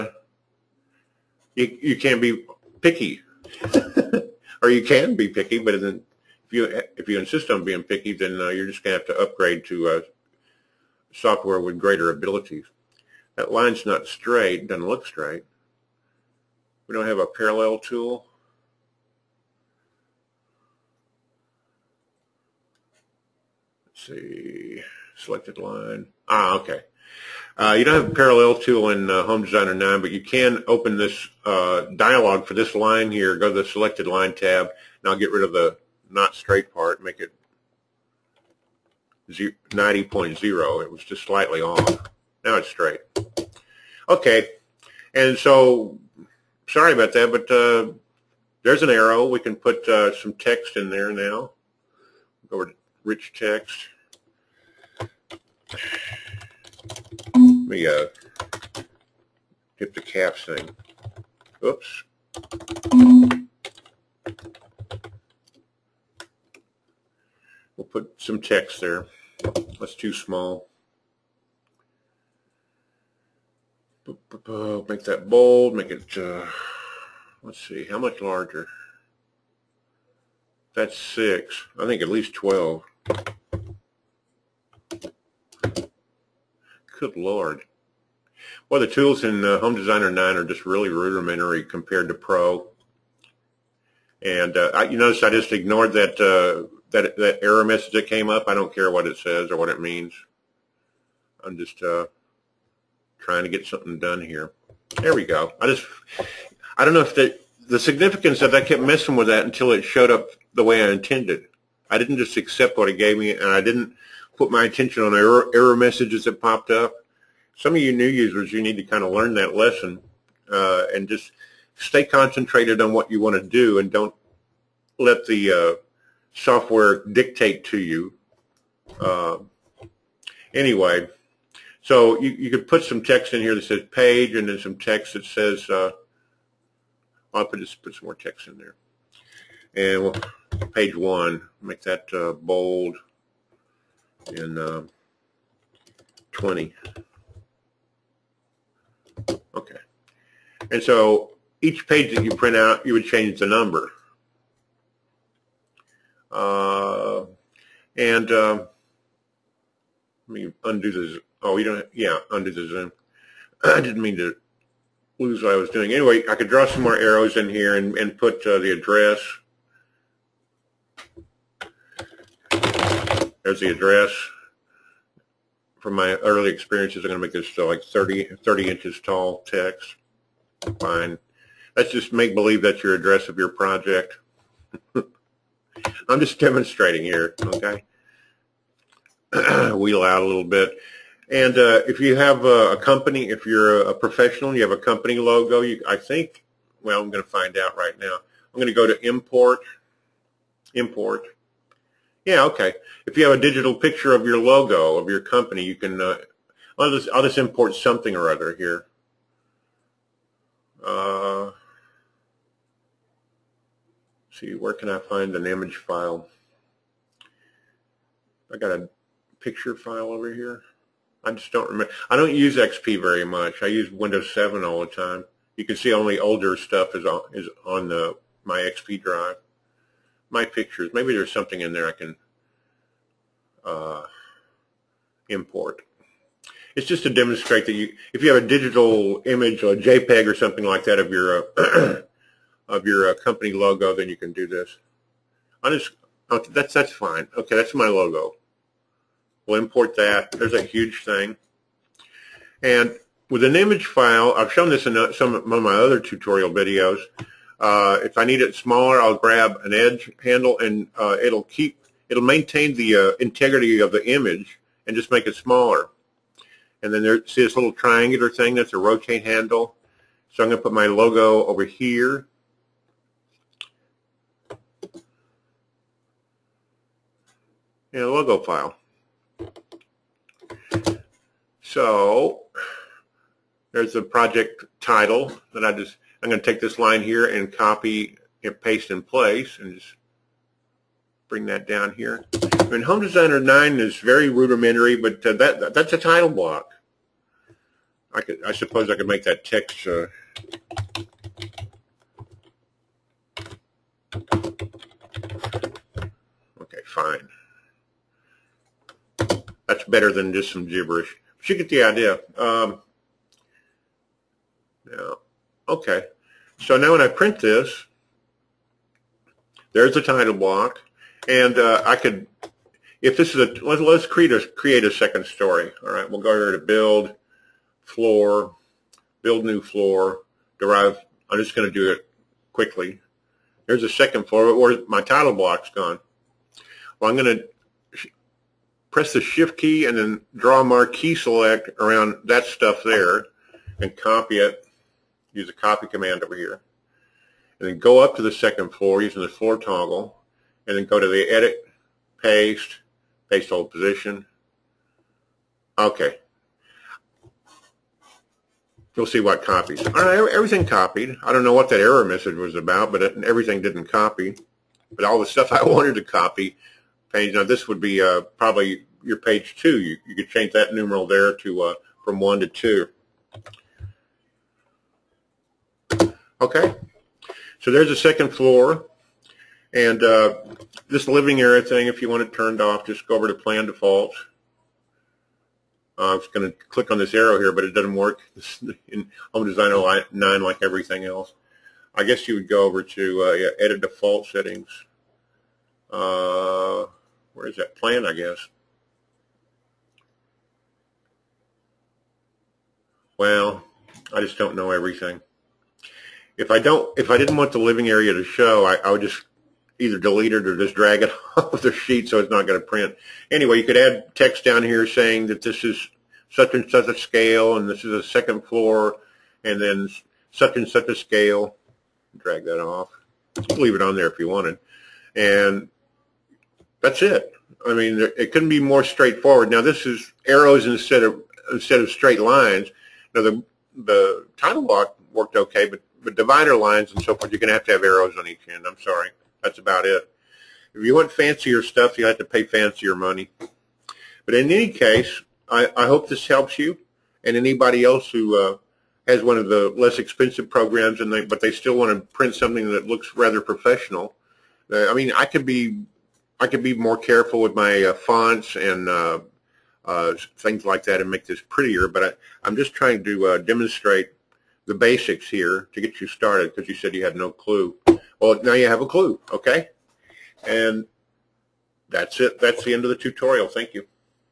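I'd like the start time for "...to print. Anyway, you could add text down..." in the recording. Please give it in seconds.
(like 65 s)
412 s.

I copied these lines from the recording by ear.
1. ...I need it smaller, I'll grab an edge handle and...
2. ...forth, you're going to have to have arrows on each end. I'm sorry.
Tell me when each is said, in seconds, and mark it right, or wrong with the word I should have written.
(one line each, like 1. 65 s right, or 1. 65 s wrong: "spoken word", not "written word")
1. 258 s right
2. 437 s right.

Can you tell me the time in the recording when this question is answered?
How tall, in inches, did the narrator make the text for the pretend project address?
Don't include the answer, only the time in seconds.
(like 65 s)
178 s.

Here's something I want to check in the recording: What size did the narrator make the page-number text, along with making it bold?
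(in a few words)
20.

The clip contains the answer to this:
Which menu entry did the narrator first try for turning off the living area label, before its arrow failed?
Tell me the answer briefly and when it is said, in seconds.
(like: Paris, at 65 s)
Plan Defaults, at 383 s.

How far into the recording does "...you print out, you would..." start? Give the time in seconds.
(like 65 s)
152 s.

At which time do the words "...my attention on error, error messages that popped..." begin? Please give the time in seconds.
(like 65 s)
114 s.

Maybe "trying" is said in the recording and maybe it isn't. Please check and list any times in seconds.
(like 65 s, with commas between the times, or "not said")
103 s, 462 s.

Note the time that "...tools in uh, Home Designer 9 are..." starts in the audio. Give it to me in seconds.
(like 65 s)
88 s.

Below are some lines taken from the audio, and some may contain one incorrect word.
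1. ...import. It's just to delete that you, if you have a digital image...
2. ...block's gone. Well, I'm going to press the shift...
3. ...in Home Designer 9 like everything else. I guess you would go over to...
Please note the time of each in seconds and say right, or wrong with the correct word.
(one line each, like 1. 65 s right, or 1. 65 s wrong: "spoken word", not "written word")
1. 235 s wrong: "demonstrate", not "delete"
2. 335 s right
3. 388 s right.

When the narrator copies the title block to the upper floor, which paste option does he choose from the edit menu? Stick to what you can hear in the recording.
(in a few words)
Paste hold position.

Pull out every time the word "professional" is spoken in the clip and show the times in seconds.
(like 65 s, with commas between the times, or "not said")
193 s, 453 s.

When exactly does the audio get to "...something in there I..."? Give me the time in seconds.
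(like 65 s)
231 s.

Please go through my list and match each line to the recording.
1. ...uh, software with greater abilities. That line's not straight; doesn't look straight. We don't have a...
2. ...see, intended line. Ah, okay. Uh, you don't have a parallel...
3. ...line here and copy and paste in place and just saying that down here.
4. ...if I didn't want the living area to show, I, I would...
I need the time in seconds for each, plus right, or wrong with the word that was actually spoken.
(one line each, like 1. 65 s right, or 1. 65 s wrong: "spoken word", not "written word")
1. 9 s right
2. 24 s wrong: "selected", not "intended"
3. 286 s wrong: "bring", not "saying"
4. 406 s right.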